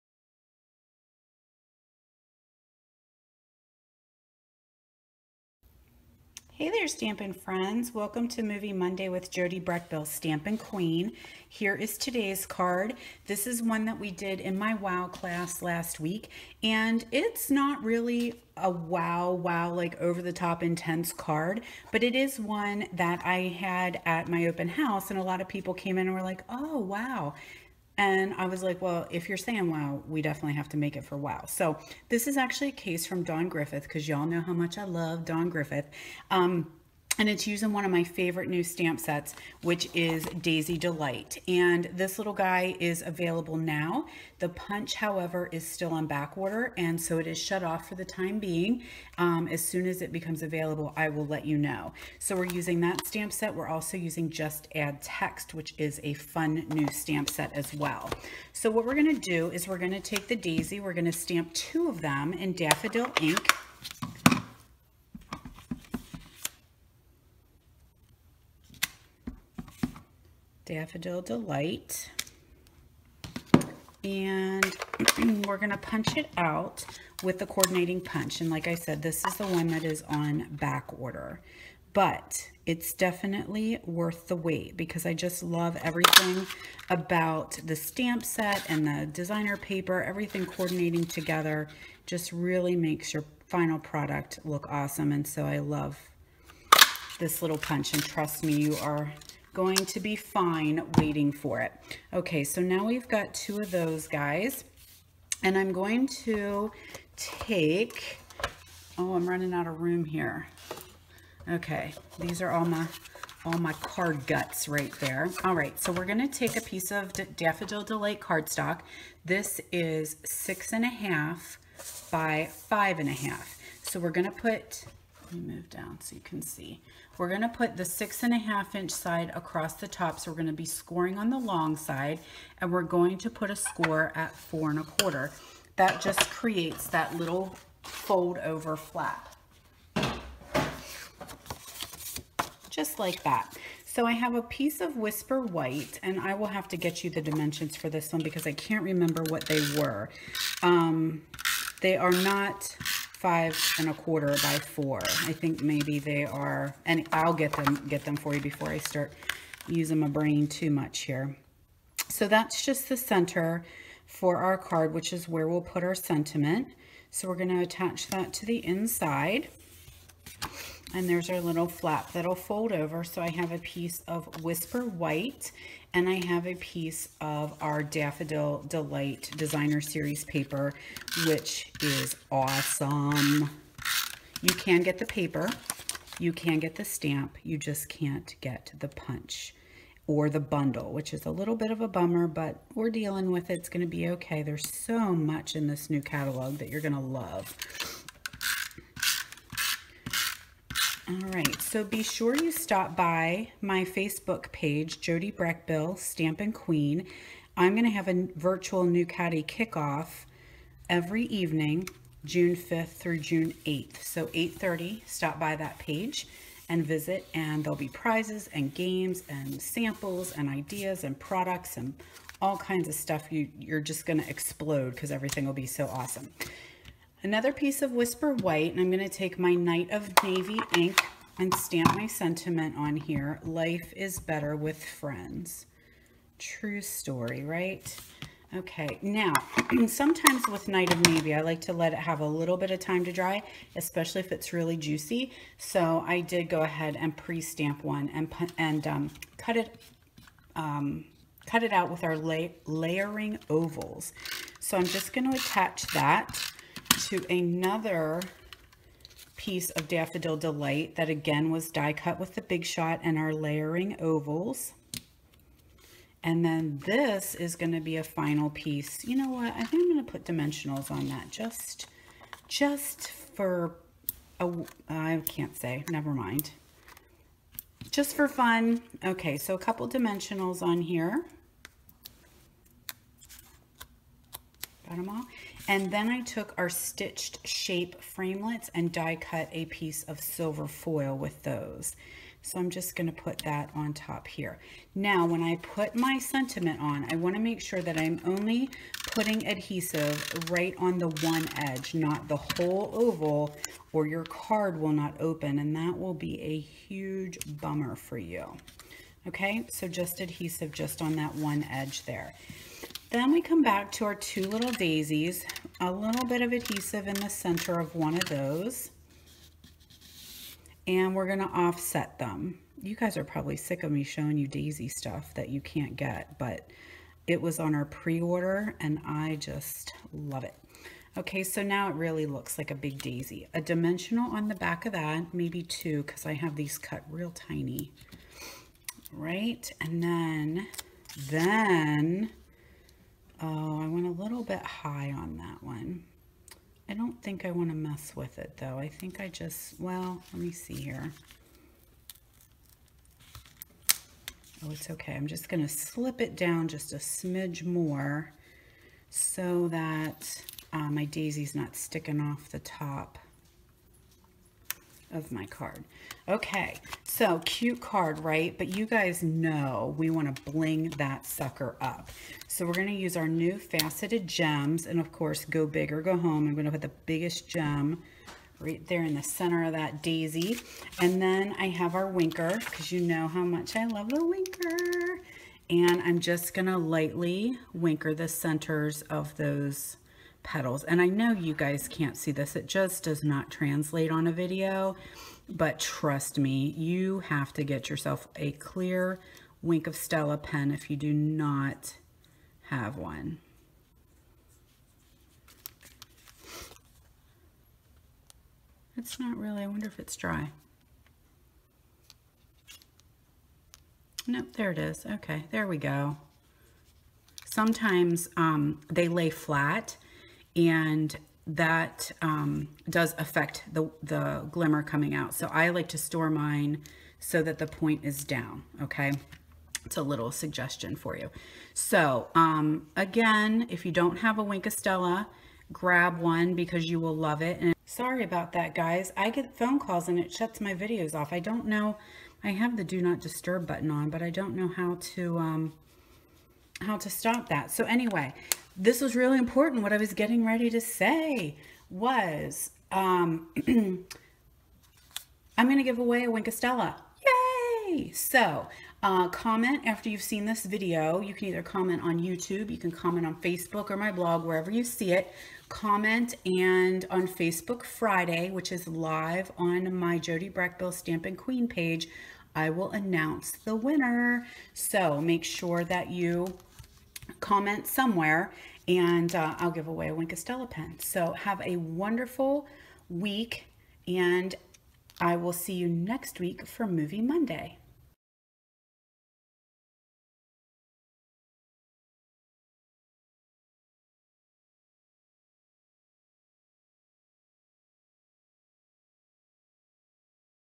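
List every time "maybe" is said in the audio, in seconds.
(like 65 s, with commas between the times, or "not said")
155 s, 335 s.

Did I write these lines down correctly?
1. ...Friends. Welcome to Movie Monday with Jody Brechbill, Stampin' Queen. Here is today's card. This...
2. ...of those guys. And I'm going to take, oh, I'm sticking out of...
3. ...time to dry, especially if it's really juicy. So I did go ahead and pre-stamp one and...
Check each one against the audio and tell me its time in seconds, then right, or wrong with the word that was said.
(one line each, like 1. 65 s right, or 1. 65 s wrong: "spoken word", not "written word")
1. 7 s right
2. 103 s wrong: "running", not "sticking"
3. 242 s right.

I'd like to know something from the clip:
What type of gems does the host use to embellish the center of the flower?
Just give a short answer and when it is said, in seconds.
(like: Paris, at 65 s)
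faceted gems, at 373 s.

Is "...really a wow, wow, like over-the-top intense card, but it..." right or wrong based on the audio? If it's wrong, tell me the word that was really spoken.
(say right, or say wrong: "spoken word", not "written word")
right.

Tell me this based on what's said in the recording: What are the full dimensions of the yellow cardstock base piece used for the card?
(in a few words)
6 1/2 by 5 1/2.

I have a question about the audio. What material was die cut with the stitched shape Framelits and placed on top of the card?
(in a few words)
silver foil.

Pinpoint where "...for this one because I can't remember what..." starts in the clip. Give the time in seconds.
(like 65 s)
147 s.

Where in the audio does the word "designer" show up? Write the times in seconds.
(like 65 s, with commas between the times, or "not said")
89 s, 179 s.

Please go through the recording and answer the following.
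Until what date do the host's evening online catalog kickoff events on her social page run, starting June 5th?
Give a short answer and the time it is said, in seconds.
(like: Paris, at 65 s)
June 8th, at 213 s.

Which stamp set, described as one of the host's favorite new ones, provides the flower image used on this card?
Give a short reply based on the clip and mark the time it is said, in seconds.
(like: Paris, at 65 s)
Daisy Delight, at 40 s.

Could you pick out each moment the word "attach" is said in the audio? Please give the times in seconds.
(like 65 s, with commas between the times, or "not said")
167 s, 255 s.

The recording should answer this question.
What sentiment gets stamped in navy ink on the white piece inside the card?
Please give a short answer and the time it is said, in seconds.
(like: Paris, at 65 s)
Life is better with friends, at 233 s.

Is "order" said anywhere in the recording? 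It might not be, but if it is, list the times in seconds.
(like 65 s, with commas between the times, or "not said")
46 s, 80 s, 327 s.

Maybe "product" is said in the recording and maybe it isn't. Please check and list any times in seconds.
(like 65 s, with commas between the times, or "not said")
93 s, 221 s.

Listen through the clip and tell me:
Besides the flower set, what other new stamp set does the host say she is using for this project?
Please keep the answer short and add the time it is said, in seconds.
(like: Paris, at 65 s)
Just Add Text, at 54 s.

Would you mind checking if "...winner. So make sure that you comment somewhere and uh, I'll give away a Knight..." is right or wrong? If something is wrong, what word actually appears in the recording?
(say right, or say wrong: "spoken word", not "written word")
wrong: "Wink", not "Knight".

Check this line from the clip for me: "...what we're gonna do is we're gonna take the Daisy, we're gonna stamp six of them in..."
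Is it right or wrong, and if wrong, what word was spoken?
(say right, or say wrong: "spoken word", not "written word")
wrong: "two", not "six".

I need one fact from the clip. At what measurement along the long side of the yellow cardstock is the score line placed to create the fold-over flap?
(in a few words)
4 1/4.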